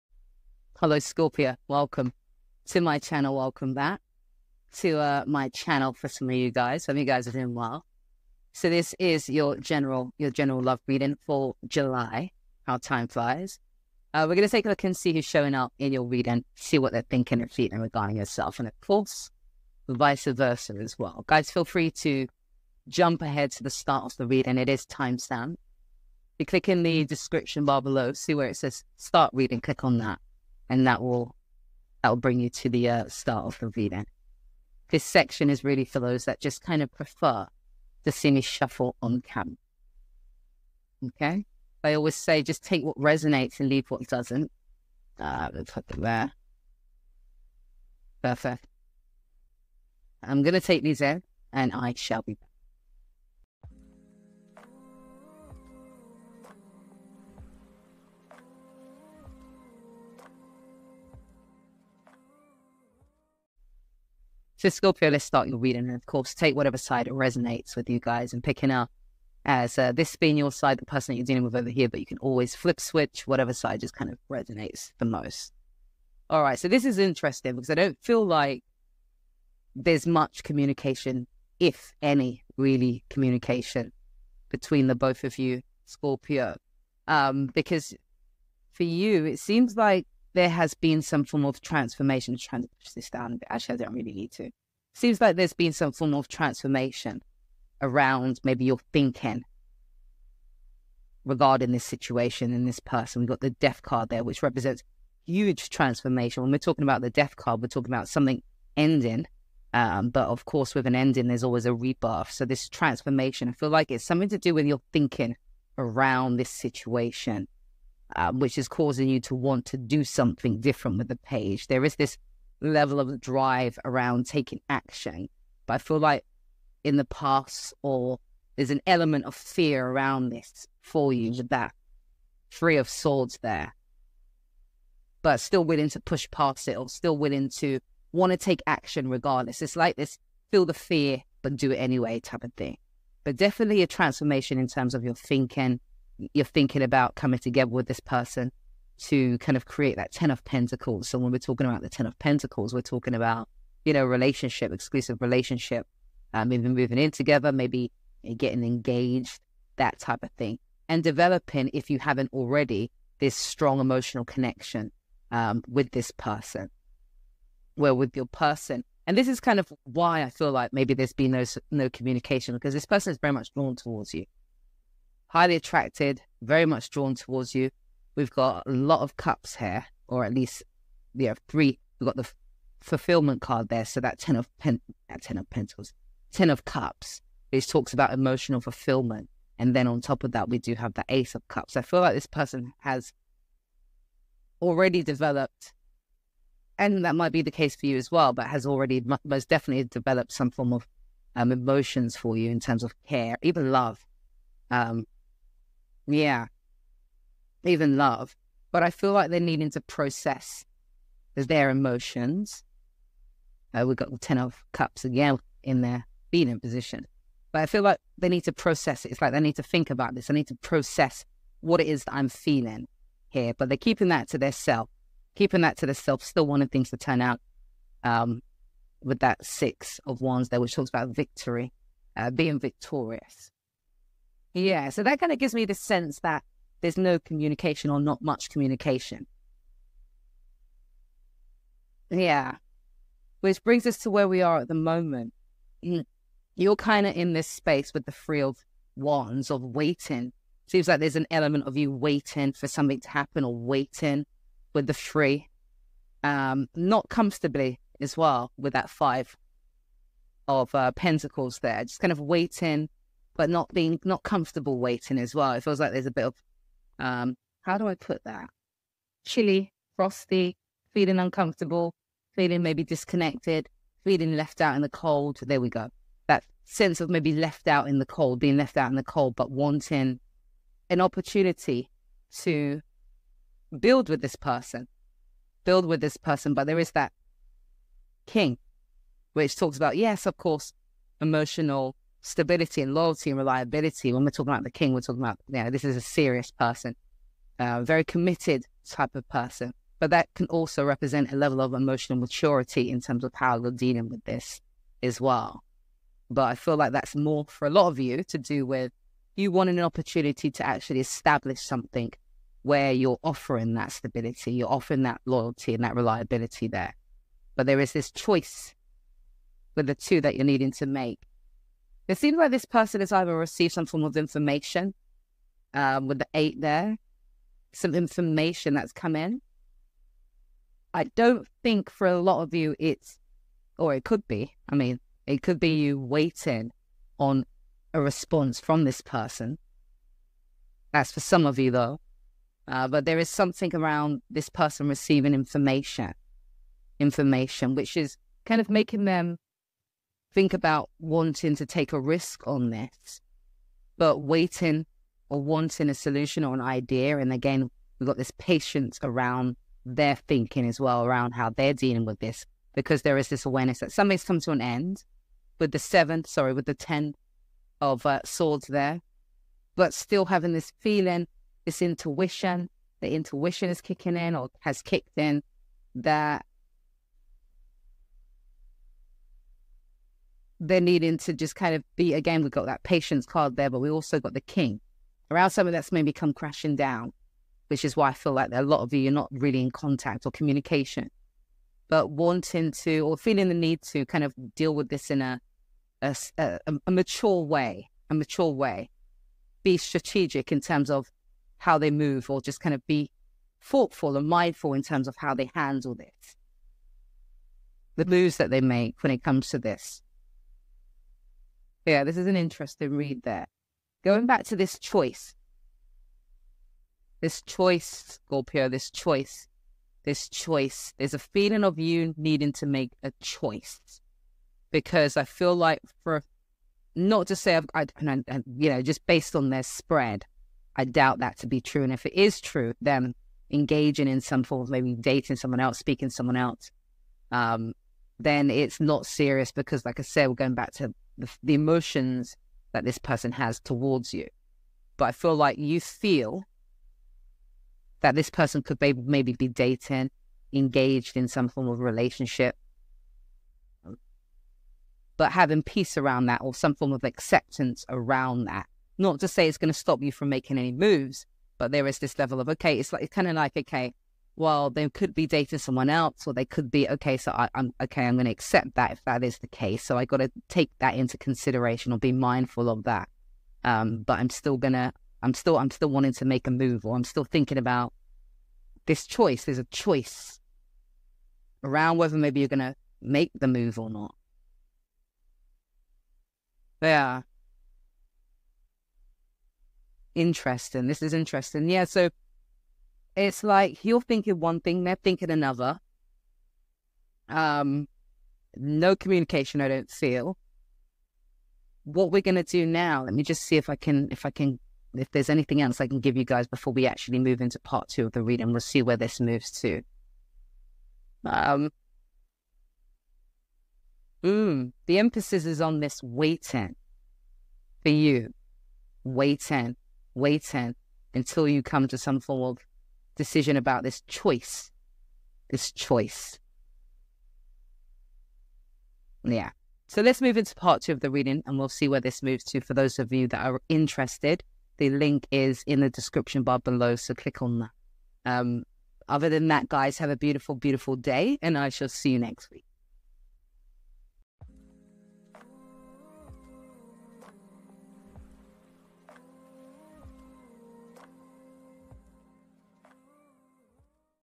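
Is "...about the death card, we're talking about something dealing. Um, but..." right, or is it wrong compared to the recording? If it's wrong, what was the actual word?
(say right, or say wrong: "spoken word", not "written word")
wrong: "ending", not "dealing".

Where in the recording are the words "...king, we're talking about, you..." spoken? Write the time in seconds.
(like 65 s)
294 s.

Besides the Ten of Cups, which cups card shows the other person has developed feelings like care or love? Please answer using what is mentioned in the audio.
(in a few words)
Ace of Cups.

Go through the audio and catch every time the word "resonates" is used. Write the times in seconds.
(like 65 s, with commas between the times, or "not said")
42 s, 67 s, 74 s.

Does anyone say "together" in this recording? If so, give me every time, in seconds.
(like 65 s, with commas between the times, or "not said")
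147 s, 157 s.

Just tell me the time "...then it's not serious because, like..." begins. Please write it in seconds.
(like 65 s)
438 s.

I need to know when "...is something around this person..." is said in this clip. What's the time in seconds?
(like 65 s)
343 s.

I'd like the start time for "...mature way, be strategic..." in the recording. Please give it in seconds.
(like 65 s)
398 s.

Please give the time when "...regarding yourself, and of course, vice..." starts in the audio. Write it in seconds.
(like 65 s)
17 s.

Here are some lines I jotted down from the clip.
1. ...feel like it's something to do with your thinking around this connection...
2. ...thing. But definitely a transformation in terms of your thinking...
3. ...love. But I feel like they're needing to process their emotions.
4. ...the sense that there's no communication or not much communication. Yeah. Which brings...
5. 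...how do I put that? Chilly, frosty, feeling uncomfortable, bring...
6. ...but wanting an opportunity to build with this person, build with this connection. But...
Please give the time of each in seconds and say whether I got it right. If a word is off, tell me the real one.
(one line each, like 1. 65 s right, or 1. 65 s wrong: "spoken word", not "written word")
1. 113 s wrong: "situation", not "connection"
2. 142 s right
3. 207 s right
4. 235 s right
5. 267 s wrong: "feeling", not "bring"
6. 279 s wrong: "person", not "connection".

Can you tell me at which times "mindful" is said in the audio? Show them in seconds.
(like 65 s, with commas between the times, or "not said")
404 s, 472 s.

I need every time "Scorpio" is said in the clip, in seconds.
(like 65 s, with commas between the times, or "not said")
0 s, 64 s, 85 s, 418 s.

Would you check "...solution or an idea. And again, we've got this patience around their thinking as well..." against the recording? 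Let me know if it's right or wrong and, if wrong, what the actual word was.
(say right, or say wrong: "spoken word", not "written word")
right.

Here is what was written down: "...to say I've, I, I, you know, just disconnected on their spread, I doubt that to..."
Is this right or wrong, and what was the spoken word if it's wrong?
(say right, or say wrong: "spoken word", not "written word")
wrong: "based", not "disconnected".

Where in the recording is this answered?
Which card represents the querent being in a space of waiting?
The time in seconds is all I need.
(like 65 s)
248 s.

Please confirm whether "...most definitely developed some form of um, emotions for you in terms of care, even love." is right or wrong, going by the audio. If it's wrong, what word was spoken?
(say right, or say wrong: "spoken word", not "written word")
right.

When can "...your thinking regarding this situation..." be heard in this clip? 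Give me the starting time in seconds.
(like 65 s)
98 s.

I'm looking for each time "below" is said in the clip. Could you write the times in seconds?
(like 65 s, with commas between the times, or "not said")
27 s, 536 s.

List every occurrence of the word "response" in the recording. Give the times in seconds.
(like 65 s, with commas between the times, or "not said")
338 s.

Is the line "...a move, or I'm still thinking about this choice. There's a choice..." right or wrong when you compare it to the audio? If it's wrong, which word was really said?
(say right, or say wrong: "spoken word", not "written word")
right.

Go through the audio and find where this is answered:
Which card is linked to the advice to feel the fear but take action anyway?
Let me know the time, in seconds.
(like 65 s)
132 s.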